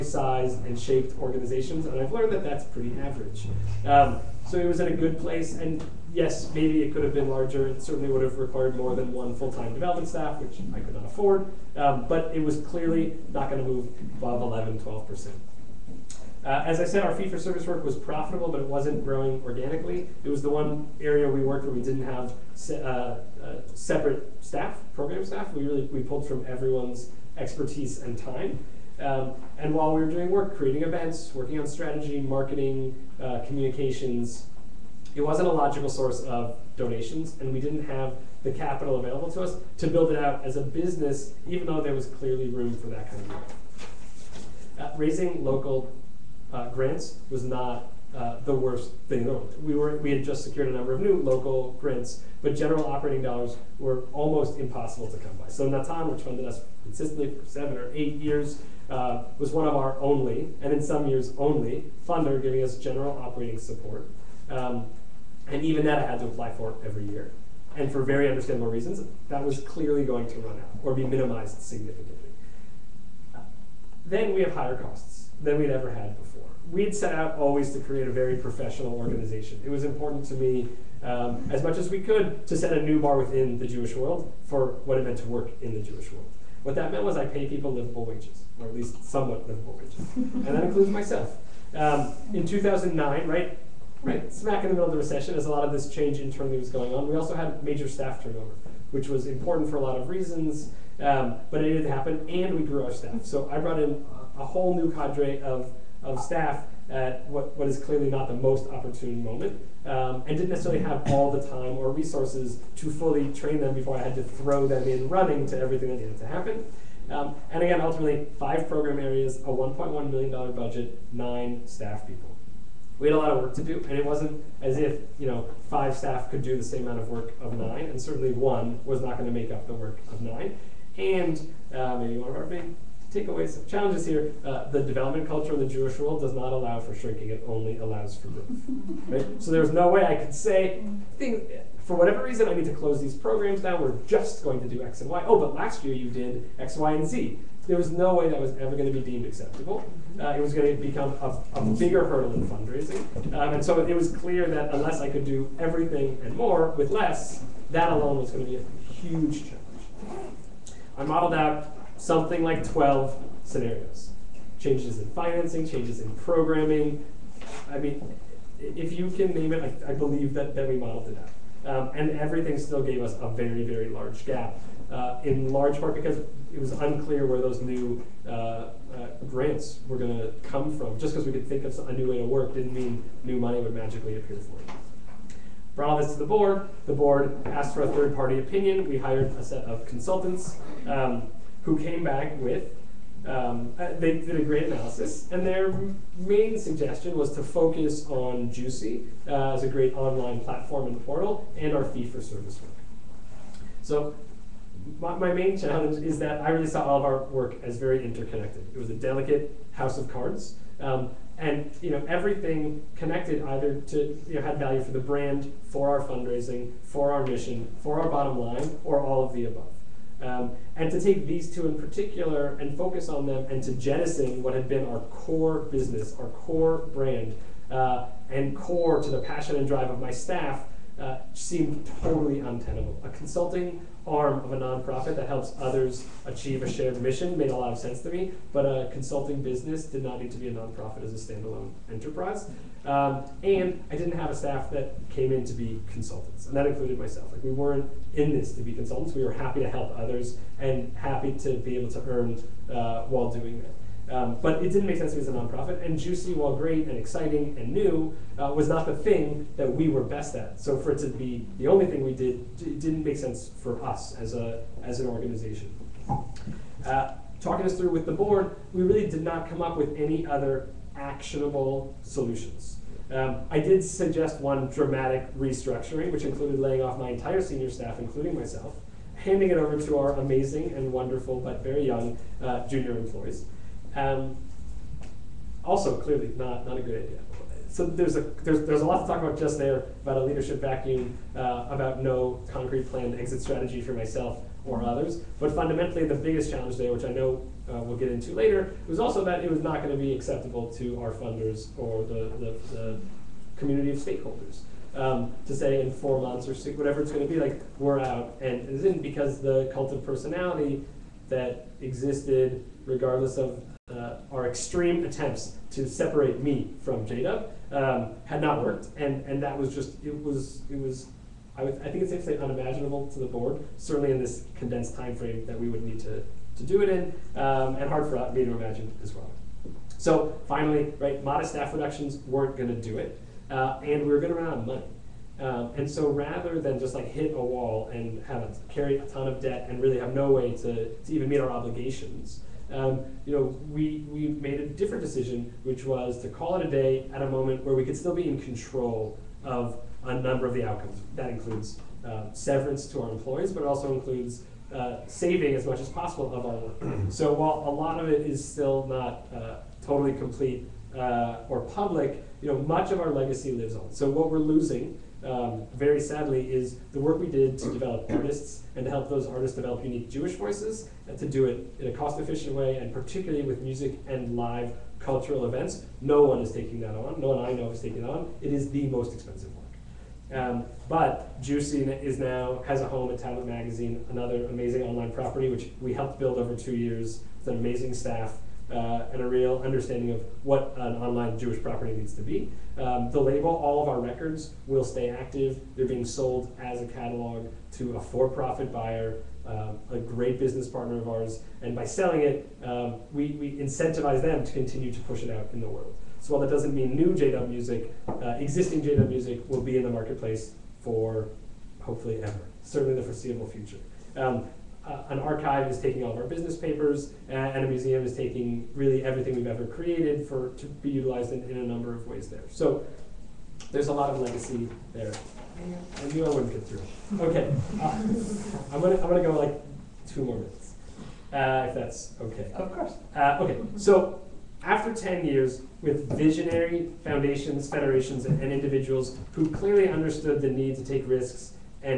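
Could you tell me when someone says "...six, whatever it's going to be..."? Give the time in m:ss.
5:06.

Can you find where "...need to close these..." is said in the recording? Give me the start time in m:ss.
2:22.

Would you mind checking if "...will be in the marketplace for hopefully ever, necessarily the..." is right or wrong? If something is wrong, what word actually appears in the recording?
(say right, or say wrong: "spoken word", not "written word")
wrong: "certainly", not "necessarily".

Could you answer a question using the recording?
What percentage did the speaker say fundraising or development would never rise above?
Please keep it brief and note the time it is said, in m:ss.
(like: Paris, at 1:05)
11, 12 percent, at 0:14.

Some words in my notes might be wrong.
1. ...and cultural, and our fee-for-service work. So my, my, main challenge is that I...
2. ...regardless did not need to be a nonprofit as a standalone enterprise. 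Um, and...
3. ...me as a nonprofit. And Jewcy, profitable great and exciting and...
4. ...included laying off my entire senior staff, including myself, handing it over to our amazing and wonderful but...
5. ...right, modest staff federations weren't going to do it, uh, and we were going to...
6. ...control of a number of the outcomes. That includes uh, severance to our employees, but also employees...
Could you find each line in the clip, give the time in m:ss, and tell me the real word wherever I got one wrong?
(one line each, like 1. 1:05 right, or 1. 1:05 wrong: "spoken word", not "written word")
1. 3:20 wrong: "portal", not "cultural"
2. 3:59 wrong: "business", not "regardless"
3. 4:15 wrong: "while", not "profitable"
4. 4:36 right
5. 5:30 wrong: "reductions", not "federations"
6. 5:48 wrong: "includes", not "employees".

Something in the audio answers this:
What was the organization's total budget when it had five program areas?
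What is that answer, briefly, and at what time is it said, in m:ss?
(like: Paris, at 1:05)
$1.1 million, at 1:59.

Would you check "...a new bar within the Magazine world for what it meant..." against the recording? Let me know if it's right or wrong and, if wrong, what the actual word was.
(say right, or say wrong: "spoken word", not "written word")
wrong: "Jewish", not "Magazine".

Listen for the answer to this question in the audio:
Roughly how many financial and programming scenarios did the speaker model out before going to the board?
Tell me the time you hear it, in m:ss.
2:42.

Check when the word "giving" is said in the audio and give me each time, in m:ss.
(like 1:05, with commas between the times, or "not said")
1:02.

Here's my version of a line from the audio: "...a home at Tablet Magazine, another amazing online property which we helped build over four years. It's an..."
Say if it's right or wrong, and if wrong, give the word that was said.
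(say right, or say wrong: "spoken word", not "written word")
wrong: "two", not "four".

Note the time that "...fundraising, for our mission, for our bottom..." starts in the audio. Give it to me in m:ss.
3:36.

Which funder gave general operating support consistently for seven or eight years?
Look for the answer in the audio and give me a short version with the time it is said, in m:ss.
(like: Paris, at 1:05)
Natan, at 0:55.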